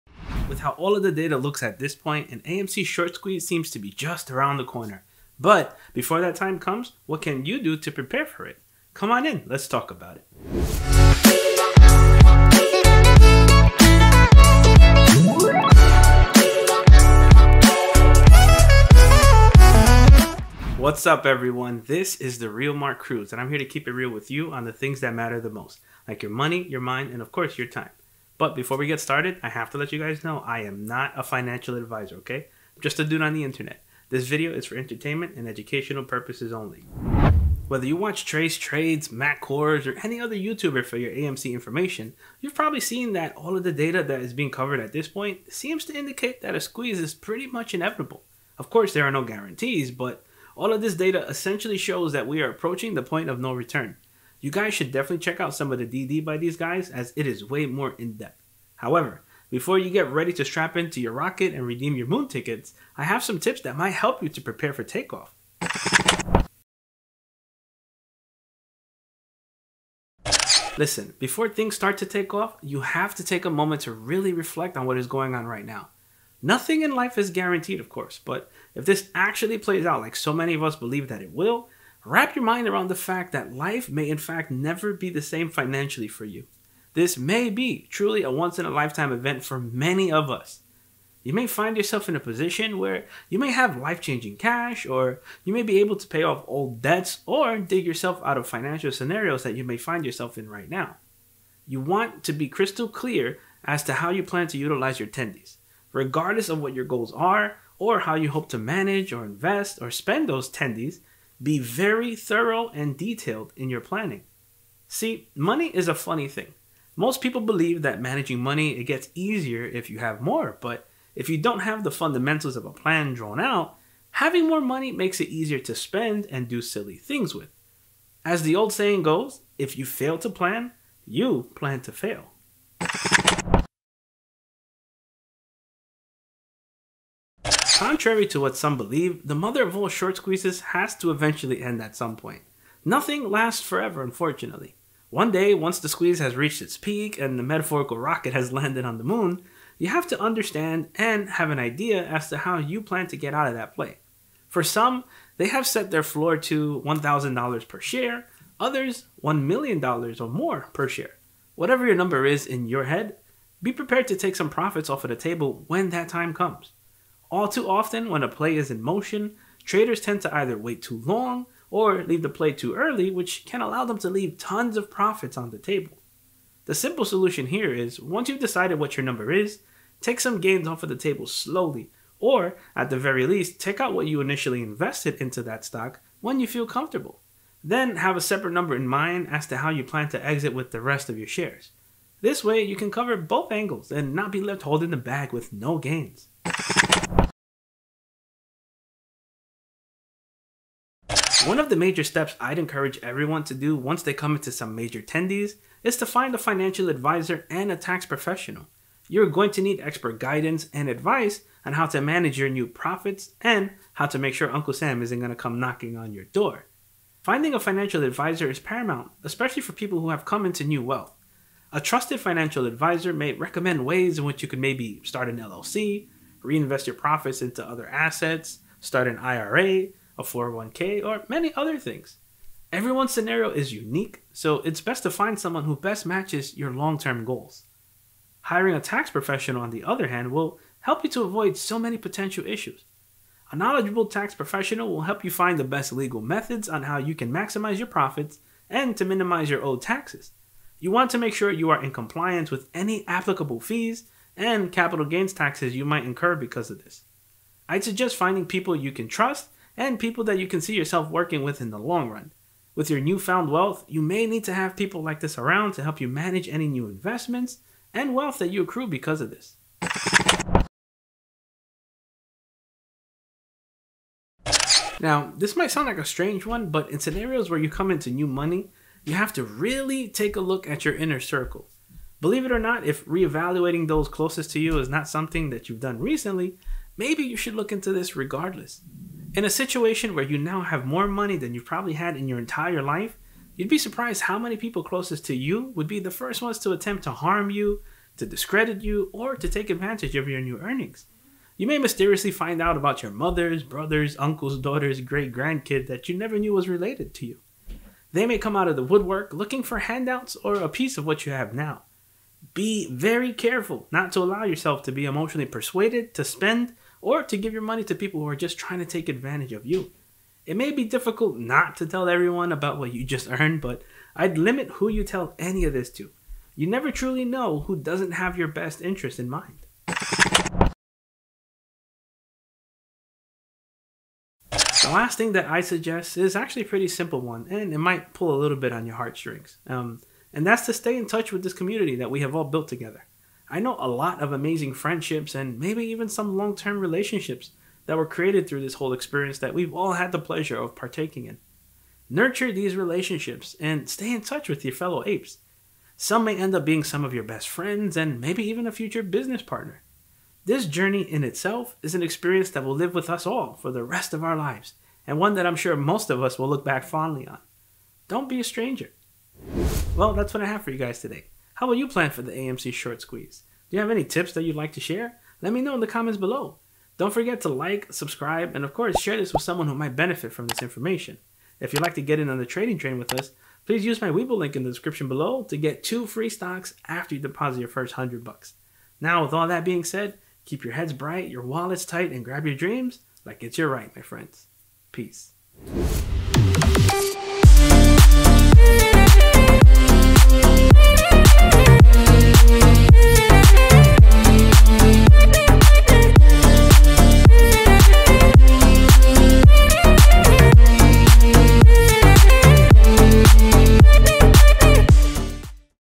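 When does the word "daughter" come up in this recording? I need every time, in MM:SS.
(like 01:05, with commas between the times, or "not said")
05:04.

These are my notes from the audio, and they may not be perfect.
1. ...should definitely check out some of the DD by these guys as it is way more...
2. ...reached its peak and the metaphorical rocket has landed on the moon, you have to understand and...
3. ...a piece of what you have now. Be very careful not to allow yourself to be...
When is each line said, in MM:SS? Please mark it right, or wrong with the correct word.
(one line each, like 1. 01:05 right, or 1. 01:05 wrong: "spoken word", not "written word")
1. 00:54 right
2. 02:26 right
3. 05:10 right.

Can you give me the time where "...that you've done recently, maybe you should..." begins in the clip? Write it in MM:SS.
04:45.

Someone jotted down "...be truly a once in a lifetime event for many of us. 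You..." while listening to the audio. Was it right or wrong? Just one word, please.
right.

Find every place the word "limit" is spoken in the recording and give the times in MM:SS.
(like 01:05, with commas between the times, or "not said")
05:24.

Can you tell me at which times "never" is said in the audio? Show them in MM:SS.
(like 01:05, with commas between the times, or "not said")
01:24, 05:06, 05:26.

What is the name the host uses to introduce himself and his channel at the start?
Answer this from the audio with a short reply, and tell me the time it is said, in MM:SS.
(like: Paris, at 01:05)
The Real Mark Cruz, at 00:22.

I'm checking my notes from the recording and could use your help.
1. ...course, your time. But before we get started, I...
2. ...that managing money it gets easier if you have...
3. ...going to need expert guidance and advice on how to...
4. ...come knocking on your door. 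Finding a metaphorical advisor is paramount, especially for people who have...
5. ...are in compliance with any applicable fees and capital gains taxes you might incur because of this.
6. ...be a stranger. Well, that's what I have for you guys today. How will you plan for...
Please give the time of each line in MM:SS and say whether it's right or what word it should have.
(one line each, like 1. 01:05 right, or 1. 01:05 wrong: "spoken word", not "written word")
1. 00:27 right
2. 01:57 right
3. 03:29 right
4. 03:35 wrong: "financial", not "metaphorical"
5. 04:11 right
6. 06:08 right.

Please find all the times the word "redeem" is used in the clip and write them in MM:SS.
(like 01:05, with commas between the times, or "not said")
01:01.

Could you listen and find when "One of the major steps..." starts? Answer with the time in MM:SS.
03:21.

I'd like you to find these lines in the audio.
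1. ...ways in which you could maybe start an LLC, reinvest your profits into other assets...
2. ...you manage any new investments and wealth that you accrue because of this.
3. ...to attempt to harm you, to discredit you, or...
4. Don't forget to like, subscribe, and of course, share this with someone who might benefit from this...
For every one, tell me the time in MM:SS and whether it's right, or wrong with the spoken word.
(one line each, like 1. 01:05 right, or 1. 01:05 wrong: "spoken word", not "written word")
1. 03:43 right
2. 04:26 right
3. 04:56 right
4. 06:16 right.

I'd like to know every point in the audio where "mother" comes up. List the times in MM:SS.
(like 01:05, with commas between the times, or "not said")
02:19, 05:03.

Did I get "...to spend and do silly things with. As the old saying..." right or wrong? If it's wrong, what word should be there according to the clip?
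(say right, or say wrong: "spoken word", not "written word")
right.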